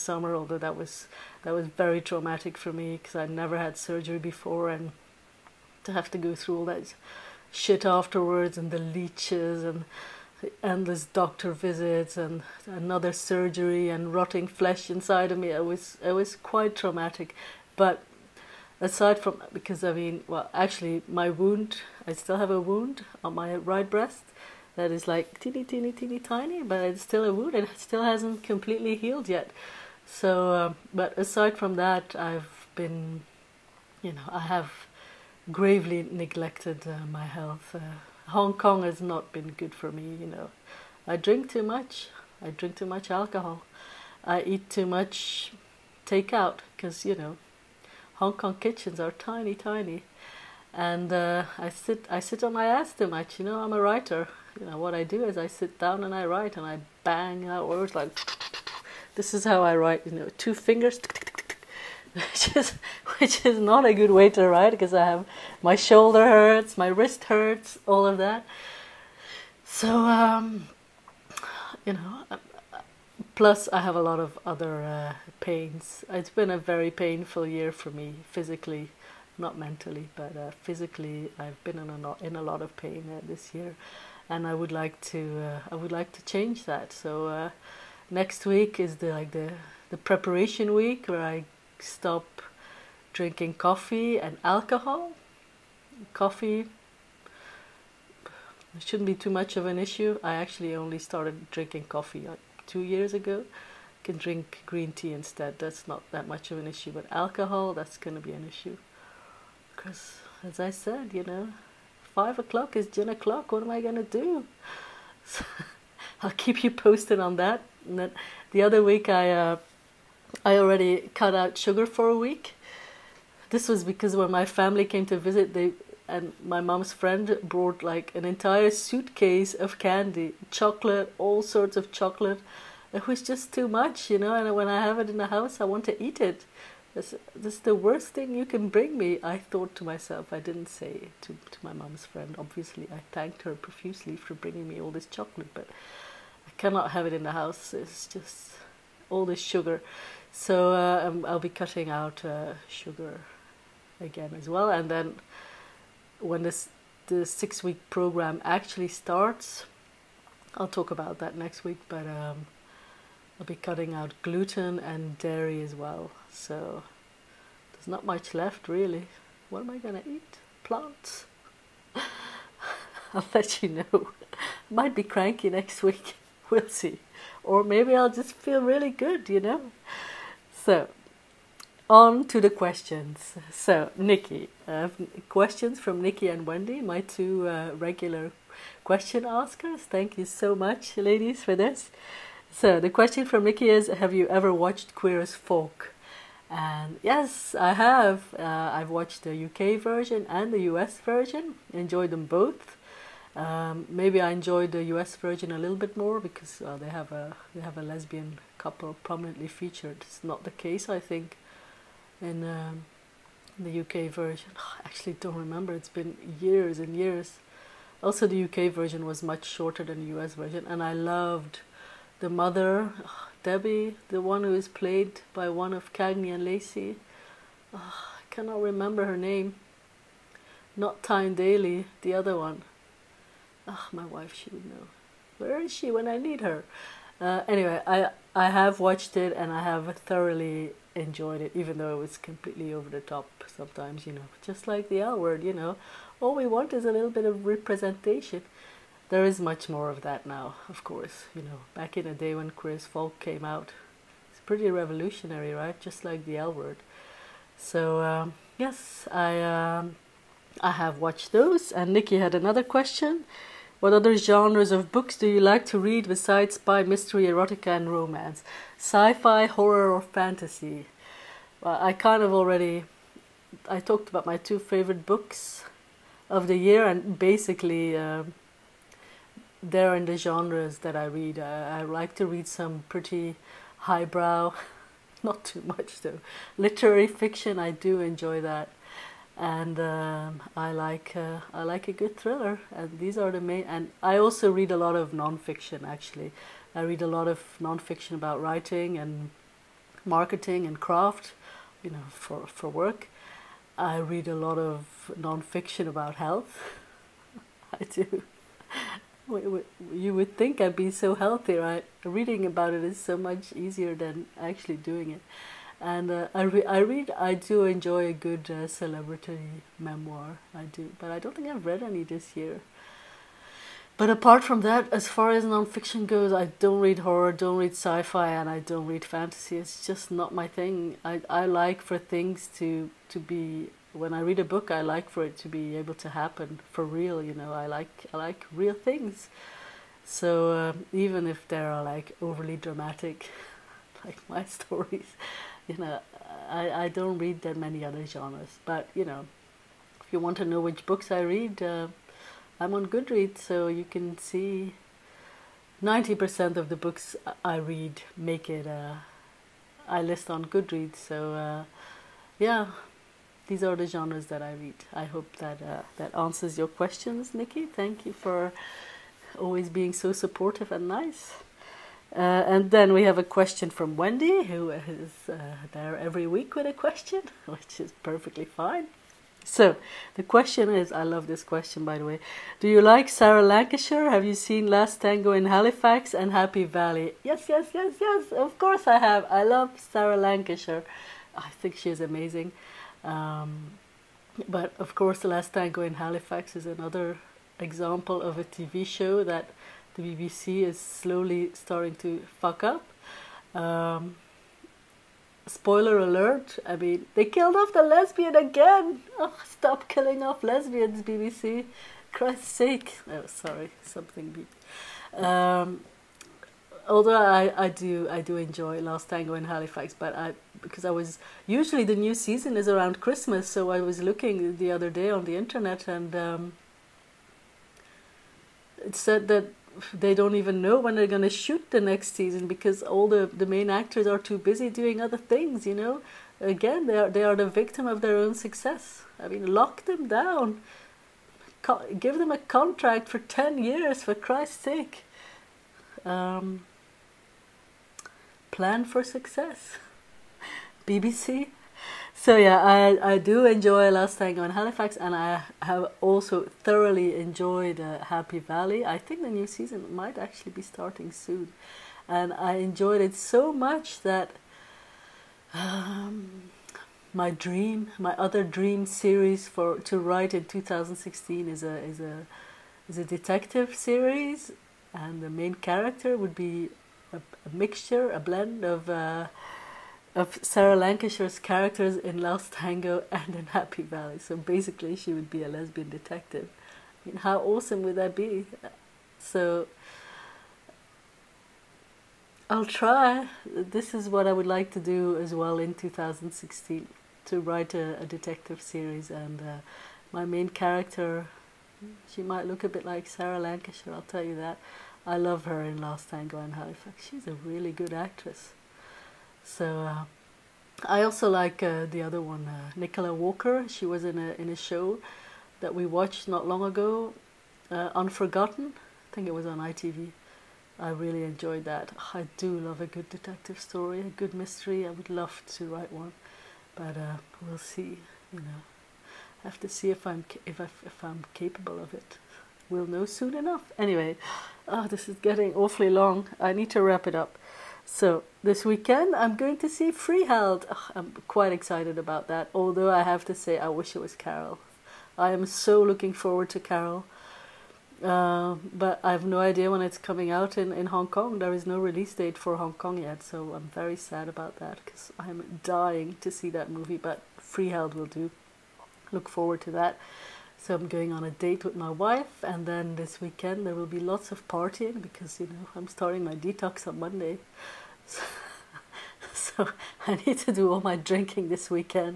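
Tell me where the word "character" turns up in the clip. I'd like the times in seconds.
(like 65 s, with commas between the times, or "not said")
475 s, 481 s, 500 s.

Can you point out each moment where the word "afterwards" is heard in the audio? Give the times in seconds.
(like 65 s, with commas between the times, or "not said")
7 s.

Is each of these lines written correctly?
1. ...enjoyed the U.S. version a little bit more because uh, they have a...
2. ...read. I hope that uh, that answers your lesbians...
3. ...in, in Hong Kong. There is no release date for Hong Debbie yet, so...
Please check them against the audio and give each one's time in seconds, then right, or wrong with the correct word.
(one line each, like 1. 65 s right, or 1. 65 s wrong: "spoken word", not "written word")
1. 204 s right
2. 364 s wrong: "questions", not "lesbians"
3. 550 s wrong: "Kong", not "Debbie".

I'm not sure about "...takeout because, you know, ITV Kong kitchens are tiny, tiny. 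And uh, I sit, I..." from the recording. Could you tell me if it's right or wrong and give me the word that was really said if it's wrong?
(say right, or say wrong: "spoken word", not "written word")
wrong: "Hong", not "ITV".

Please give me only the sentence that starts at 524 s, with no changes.
I would love to write one, but uh, we'll see.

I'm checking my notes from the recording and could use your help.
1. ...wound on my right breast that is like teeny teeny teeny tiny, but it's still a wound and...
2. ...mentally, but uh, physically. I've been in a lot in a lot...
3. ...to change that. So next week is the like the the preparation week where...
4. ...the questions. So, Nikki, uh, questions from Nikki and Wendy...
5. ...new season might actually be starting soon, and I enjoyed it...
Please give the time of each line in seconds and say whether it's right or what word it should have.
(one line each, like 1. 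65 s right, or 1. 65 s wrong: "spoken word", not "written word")
1. 22 s right
2. 79 s right
3. 86 s right
4. 182 s right
5. 459 s right.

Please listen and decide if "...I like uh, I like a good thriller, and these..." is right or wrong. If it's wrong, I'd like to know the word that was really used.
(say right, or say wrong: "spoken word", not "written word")
right.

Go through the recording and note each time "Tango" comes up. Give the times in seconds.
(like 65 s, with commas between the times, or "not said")
385 s, 395 s, 419 s, 454 s, 482 s, 506 s.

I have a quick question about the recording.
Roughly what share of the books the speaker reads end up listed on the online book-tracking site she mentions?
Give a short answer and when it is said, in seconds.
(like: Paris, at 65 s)
90%, at 355 s.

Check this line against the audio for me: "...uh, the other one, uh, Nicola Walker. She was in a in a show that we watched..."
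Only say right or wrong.
right.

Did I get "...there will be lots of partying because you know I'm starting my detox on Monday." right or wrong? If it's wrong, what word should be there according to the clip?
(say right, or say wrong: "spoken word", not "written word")
right.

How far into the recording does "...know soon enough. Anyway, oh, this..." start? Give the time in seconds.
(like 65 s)
532 s.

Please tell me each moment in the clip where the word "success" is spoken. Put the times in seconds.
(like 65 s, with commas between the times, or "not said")
438 s, 449 s.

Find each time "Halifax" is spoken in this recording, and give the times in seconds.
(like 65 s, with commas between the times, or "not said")
385 s, 395 s, 419 s, 454 s, 506 s.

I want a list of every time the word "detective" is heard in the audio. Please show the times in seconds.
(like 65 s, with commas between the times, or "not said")
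473 s, 485 s, 498 s, 523 s.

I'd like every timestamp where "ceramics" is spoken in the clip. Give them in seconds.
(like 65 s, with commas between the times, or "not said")
not said.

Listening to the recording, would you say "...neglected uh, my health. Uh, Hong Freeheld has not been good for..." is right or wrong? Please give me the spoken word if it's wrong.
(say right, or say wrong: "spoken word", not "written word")
wrong: "Kong", not "Freeheld".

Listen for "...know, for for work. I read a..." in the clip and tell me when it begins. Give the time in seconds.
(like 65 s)
301 s.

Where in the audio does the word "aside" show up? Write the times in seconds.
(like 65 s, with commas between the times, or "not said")
18 s, 31 s.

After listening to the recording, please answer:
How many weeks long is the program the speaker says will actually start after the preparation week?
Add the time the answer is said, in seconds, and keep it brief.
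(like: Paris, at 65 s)
6 weeks, at 157 s.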